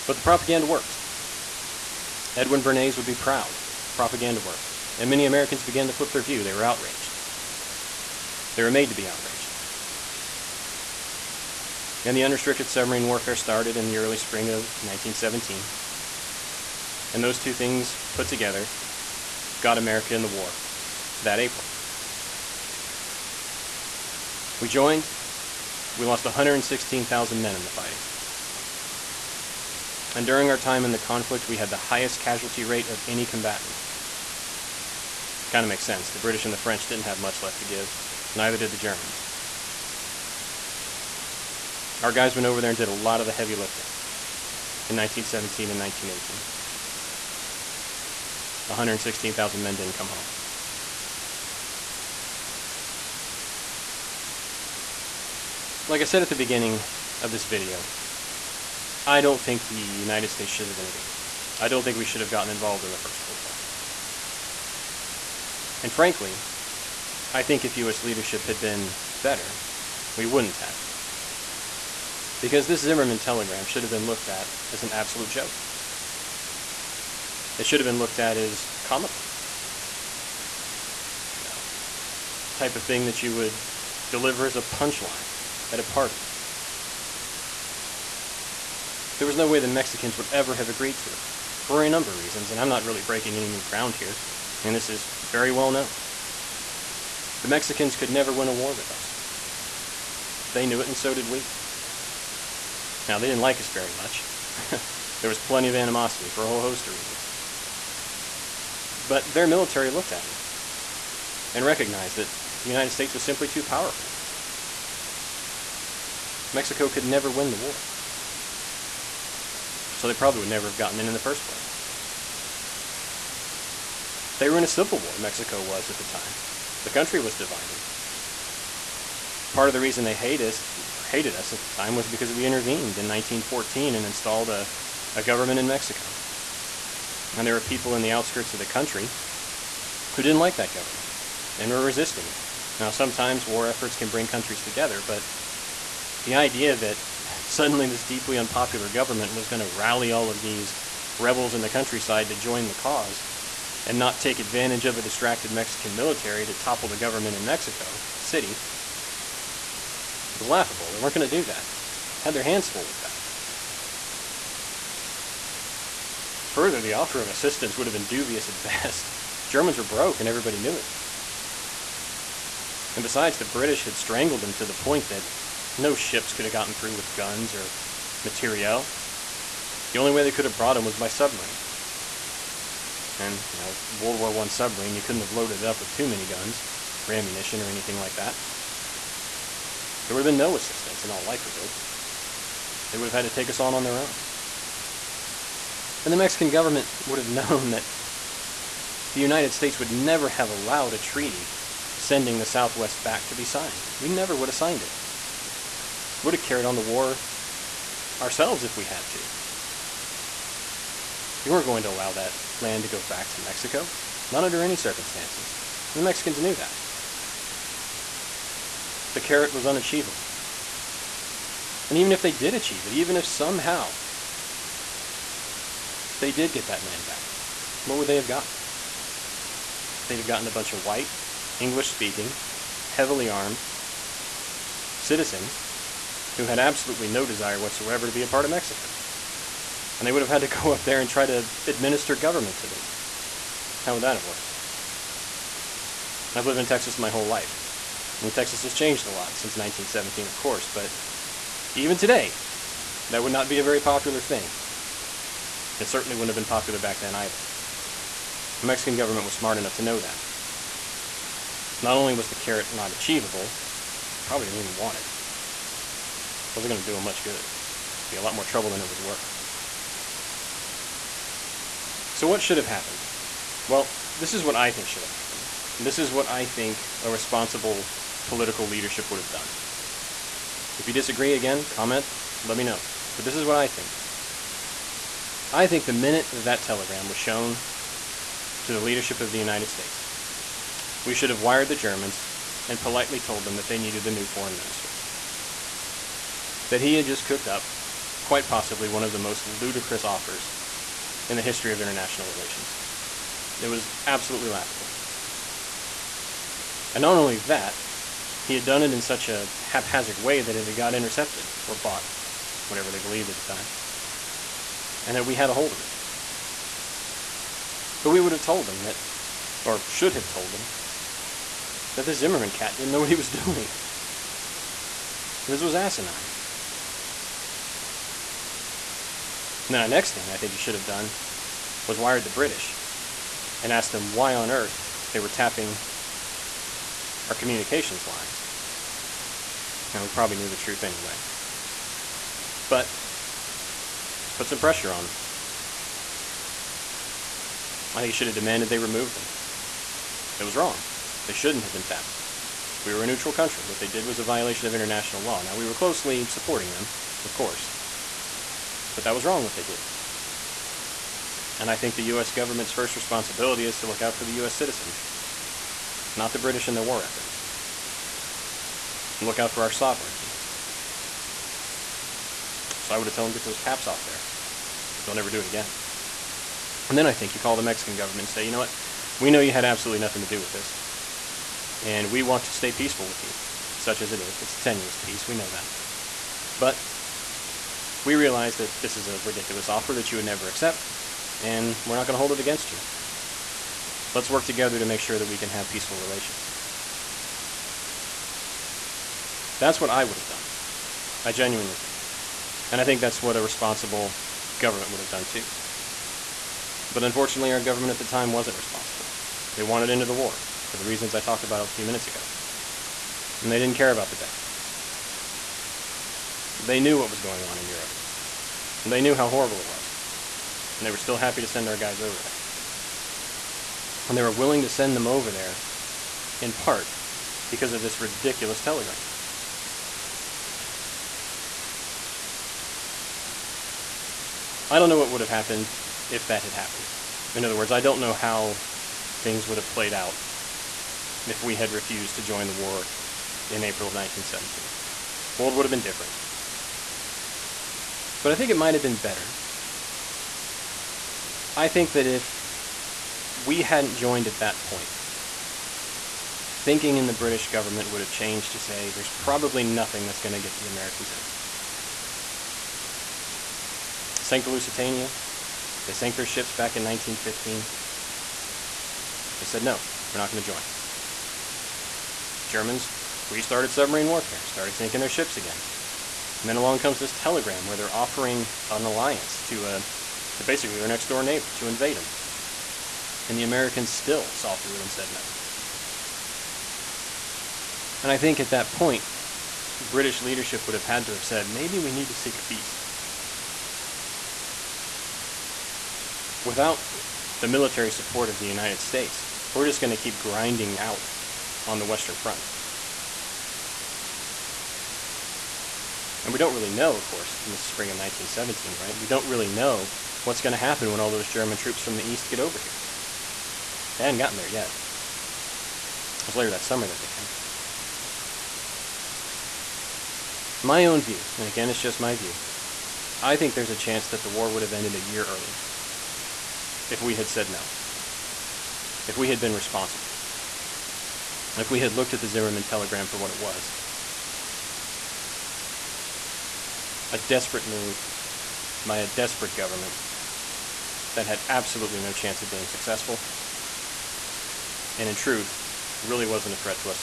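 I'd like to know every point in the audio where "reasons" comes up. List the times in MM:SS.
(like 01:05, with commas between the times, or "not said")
01:32, 01:46, 02:09, 06:50.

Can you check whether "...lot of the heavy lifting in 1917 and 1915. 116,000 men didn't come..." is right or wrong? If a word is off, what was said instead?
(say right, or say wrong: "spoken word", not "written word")
wrong: "1918", not "1915".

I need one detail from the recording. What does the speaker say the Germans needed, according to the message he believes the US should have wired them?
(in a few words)
A new foreign minister.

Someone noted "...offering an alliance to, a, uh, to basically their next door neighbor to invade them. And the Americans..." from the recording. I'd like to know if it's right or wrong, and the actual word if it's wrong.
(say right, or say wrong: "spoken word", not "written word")
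right.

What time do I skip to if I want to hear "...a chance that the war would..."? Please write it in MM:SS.
08:43.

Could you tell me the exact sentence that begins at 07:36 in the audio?
Thinking in the British government would have changed to say there's probably nothing that's going to get the Americans in.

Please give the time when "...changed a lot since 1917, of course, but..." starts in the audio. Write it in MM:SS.
04:08.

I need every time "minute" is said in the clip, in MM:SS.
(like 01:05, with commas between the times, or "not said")
04:45, 06:51.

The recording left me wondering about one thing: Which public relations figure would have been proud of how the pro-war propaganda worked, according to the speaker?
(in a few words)
Edwin Bernays.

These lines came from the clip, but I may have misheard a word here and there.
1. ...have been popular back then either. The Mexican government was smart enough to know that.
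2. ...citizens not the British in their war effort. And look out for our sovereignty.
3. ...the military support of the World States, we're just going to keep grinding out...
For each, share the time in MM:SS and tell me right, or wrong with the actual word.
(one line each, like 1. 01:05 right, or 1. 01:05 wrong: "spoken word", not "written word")
1. 04:16 right
2. 06:04 right
3. 08:17 wrong: "United", not "World".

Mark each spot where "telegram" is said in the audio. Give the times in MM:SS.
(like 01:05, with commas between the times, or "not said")
01:13, 04:46, 07:08, 07:57, 08:52.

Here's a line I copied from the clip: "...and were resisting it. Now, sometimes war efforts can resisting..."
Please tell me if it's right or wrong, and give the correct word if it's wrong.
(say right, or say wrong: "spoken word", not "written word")
wrong: "bring", not "resisting".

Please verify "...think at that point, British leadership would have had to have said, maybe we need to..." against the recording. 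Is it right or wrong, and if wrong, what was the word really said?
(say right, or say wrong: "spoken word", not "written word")
right.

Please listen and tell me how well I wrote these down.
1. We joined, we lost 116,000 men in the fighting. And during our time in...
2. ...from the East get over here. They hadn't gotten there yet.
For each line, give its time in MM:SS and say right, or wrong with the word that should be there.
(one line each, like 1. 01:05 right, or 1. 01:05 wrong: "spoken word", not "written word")
1. 00:24 right
2. 08:31 right.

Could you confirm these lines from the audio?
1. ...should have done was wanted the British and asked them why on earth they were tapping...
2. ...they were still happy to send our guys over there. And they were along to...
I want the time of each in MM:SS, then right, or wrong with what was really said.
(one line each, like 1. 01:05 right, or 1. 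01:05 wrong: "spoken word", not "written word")
1. 05:30 wrong: "wired", not "wanted"
2. 07:00 wrong: "willing", not "along".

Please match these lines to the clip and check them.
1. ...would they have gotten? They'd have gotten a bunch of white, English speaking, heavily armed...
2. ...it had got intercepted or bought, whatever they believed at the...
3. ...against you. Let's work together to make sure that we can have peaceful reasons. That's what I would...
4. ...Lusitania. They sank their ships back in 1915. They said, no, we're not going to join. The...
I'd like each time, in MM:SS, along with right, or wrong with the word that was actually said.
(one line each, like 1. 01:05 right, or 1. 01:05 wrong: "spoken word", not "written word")
1. 03:47 right
2. 05:10 right
3. 06:32 wrong: "relations", not "reasons"
4. 07:44 right.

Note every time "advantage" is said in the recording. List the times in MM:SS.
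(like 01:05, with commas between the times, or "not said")
02:34.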